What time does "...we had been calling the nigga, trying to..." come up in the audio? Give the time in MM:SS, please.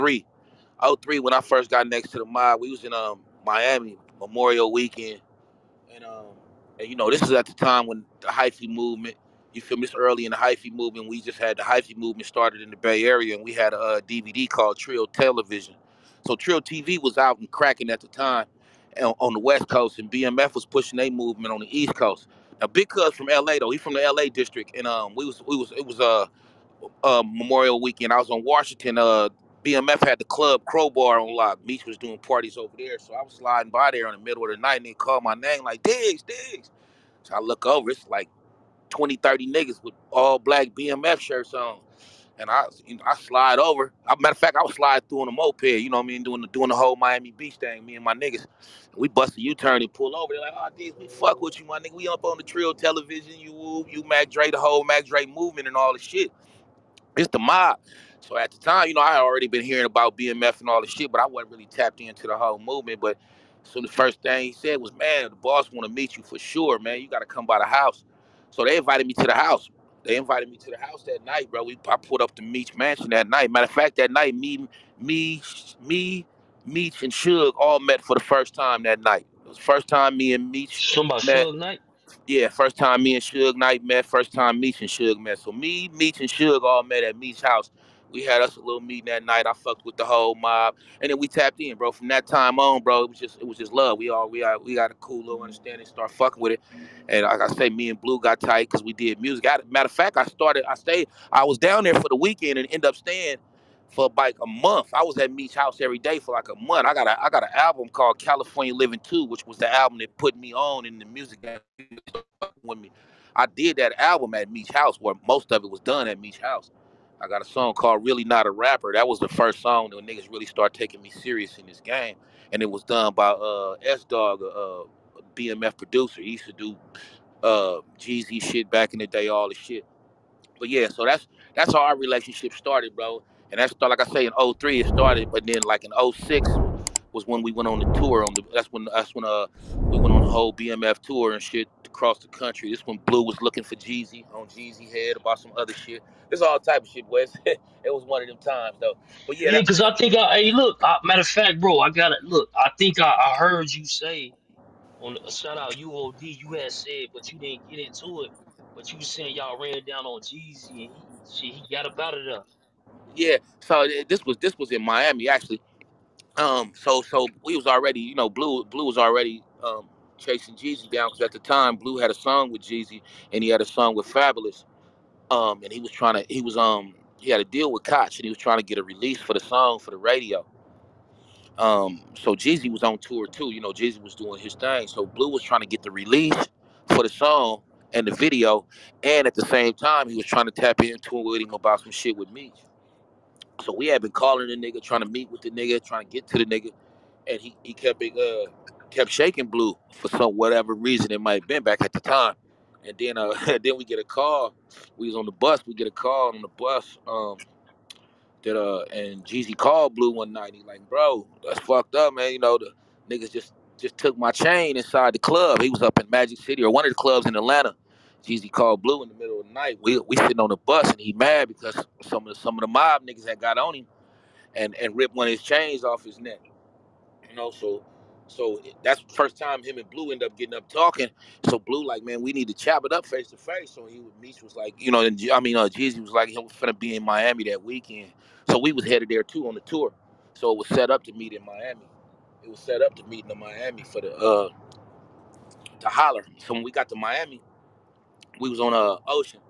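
03:13.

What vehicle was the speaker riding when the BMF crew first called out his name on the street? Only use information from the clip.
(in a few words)
A moped.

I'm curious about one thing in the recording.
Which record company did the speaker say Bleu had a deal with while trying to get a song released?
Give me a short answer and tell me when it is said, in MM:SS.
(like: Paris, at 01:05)
Koch, at 02:57.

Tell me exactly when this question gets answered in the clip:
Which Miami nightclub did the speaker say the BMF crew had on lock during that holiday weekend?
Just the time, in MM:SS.
00:30.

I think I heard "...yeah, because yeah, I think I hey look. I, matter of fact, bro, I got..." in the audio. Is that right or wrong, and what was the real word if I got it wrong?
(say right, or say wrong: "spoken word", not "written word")
right.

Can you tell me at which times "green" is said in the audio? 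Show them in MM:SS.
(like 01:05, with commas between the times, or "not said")
not said.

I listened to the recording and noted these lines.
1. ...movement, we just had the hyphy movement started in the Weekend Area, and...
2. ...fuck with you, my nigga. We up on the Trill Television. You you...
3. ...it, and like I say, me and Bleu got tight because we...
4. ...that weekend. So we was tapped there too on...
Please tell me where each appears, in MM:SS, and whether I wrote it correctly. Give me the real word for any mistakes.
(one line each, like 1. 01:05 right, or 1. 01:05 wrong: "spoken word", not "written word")
1. 00:10 wrong: "Bay", not "Weekend"
2. 00:51 right
3. 01:36 right
4. 03:57 wrong: "headed", not "tapped".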